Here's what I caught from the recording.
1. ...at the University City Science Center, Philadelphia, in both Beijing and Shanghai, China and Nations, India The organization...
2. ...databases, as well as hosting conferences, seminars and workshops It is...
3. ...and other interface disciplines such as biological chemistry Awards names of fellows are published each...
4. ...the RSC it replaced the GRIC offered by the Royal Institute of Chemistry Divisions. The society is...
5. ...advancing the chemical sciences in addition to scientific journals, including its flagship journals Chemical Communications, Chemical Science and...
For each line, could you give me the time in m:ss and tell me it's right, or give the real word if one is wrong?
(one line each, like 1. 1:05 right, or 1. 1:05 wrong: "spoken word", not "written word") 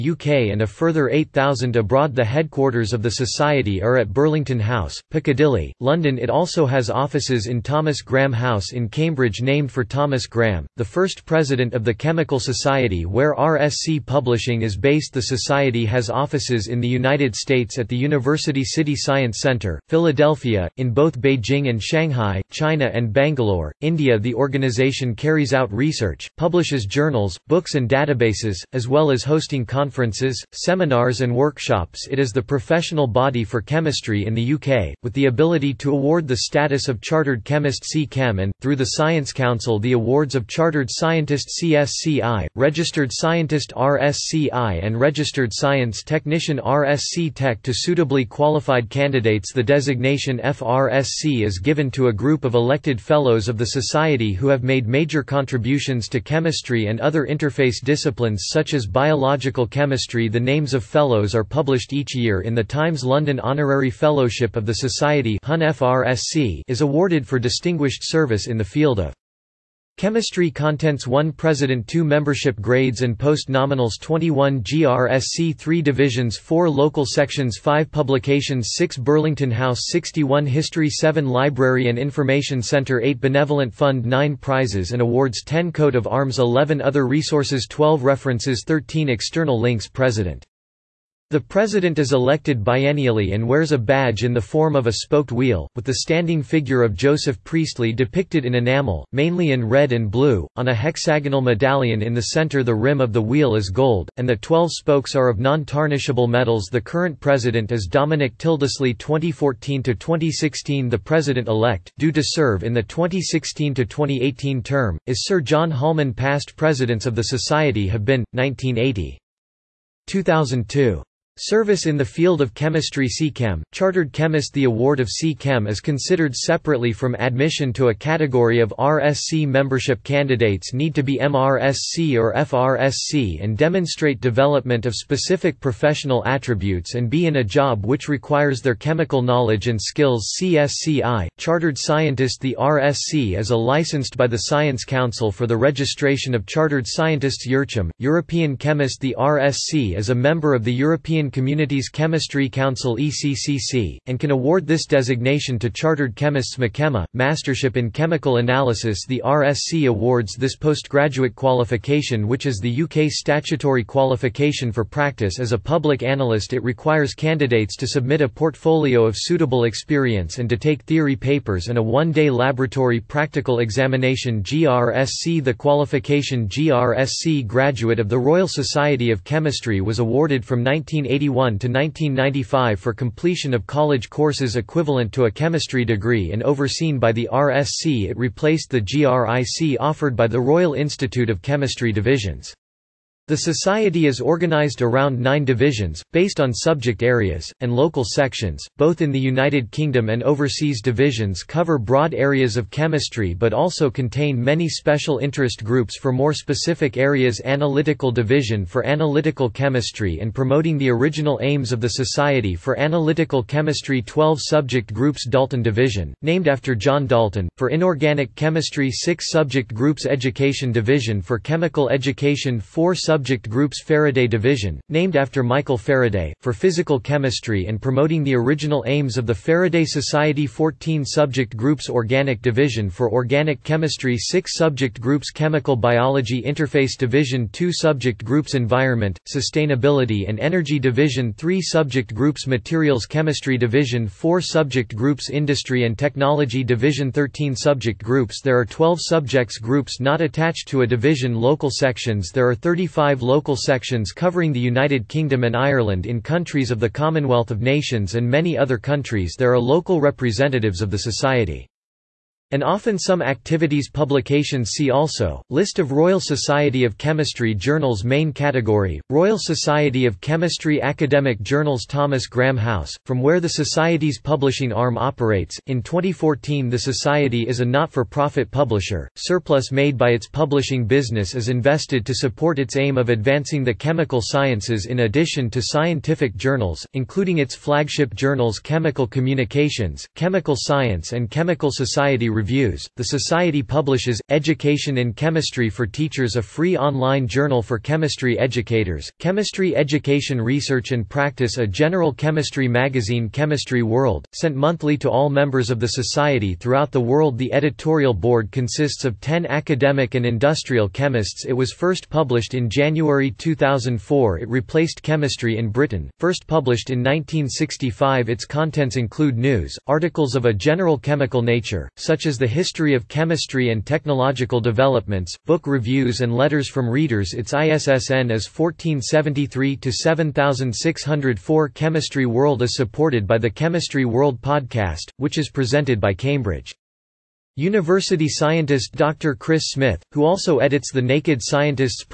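1. 0:17 wrong: "Bangalore", not "Nations"
2. 0:27 right
3. 0:56 wrong: "The", not "Awards"
4. 3:07 right
5. 4:43 right.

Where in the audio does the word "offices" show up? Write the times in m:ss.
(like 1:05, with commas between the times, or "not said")
0:06, 0:16.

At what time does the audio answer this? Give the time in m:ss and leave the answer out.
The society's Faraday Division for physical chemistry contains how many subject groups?
3:50.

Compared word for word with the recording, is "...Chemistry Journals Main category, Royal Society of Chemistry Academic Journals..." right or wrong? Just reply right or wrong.
right.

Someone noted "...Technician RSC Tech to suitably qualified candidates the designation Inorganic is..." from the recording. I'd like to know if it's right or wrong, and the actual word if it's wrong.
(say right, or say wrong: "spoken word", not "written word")
wrong: "FRSC", not "Inorganic".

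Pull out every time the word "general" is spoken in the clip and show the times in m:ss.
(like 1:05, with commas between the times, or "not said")
5:01, 5:20.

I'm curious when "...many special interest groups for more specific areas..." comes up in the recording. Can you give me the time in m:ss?
3:24.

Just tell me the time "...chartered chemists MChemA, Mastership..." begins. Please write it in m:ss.
2:35.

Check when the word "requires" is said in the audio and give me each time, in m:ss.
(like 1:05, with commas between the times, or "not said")
2:18, 2:46.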